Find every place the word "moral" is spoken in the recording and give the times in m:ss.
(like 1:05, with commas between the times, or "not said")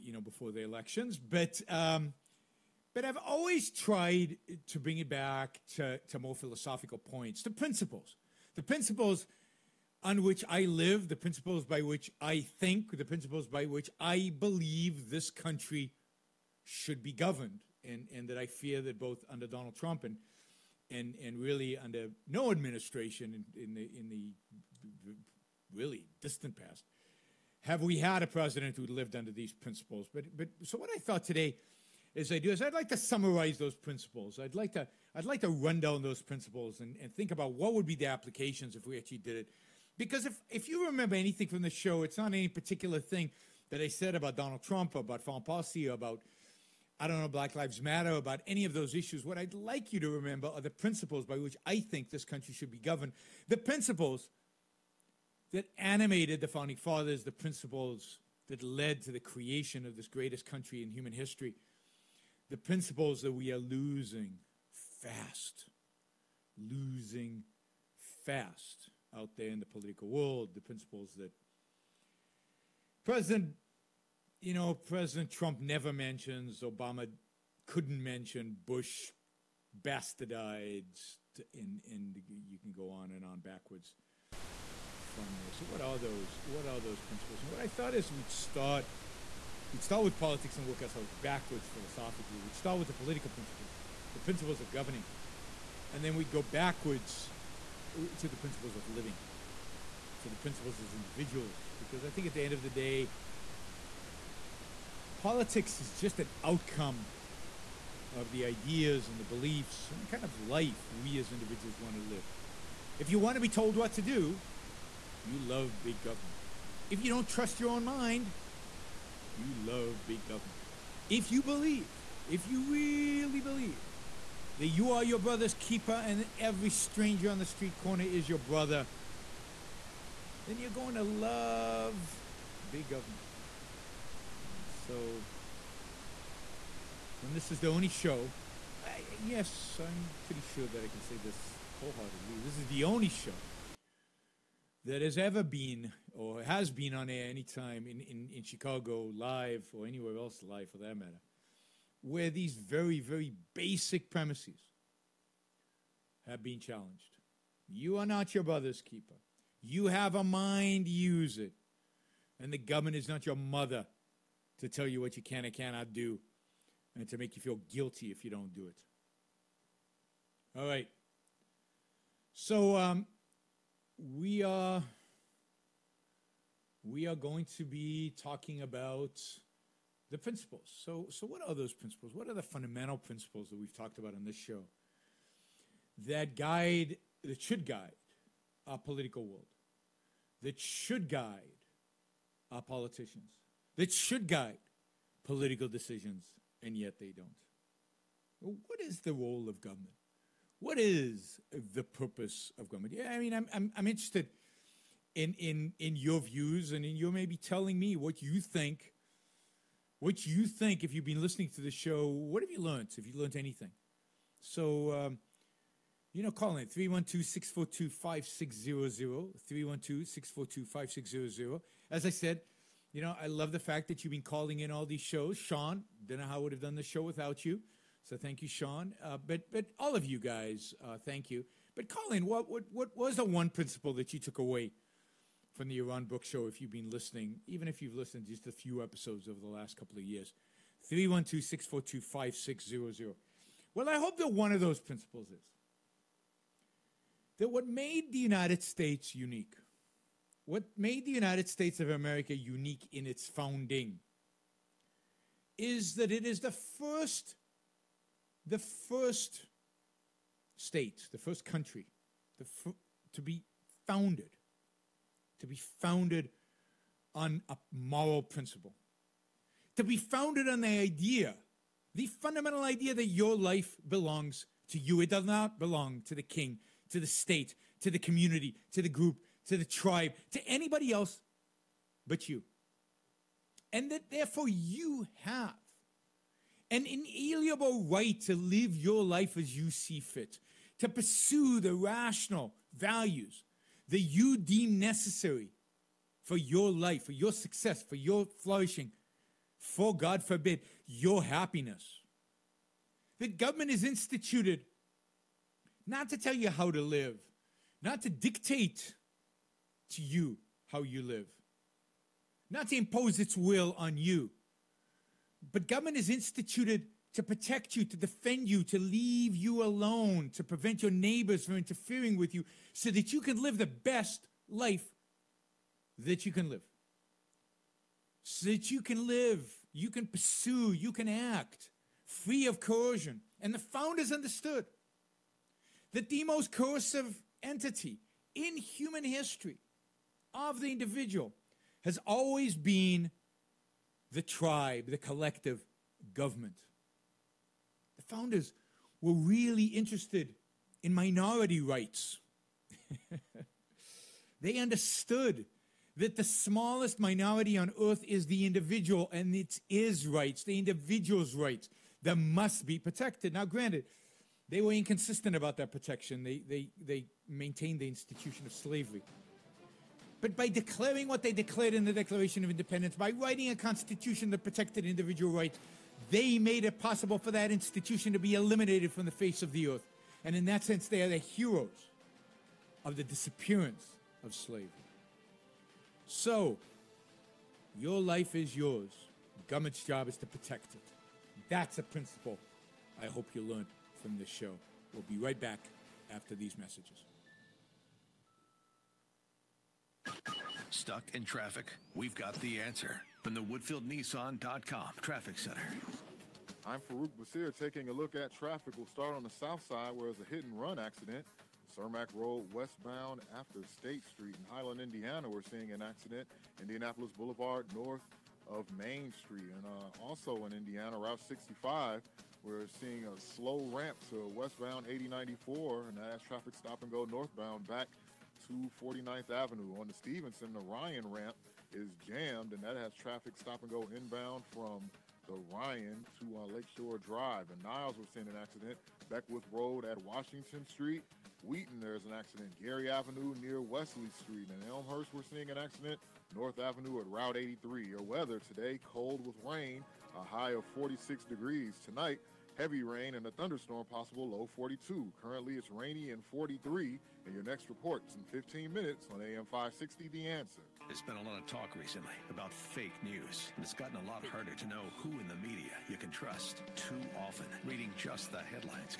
4:27.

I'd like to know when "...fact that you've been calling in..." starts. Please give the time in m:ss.
3:43.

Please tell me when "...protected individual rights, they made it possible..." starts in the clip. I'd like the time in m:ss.
6:14.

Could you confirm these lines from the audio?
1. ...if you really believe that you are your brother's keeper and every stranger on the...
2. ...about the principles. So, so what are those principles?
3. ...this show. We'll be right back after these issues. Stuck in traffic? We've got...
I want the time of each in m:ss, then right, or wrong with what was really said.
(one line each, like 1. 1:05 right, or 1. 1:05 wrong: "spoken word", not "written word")
1. 2:02 right
2. 2:58 right
3. 6:34 wrong: "messages", not "issues".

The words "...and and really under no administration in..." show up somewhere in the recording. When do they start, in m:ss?
0:20.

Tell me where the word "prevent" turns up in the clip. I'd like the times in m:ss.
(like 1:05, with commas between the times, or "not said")
5:20.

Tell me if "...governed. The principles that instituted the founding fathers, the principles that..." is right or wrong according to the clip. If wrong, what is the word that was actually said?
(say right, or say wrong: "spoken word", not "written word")
wrong: "animated", not "instituted".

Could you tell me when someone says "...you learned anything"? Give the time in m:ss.
3:33.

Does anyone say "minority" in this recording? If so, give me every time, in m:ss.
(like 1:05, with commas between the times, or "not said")
5:50, 5:56.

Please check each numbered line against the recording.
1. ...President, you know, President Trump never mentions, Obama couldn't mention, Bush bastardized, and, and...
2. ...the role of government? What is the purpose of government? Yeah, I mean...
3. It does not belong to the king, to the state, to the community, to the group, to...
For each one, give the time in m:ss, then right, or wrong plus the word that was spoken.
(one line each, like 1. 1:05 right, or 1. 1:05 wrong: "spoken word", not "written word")
1. 1:13 right
2. 3:19 right
3. 4:35 right.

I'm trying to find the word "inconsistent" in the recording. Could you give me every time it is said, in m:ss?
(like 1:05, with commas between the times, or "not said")
6:04.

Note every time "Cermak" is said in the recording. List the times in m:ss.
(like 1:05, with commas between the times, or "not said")
6:51.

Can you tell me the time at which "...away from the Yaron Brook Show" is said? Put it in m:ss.
3:54.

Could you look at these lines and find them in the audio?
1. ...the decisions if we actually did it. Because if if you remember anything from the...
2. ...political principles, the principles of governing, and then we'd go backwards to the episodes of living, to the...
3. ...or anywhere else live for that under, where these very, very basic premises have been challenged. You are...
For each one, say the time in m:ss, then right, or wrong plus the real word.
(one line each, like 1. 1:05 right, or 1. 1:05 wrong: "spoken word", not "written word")
1. 0:37 wrong: "applications", not "decisions"
2. 1:32 wrong: "principles", not "episodes"
3. 2:29 wrong: "matter", not "under".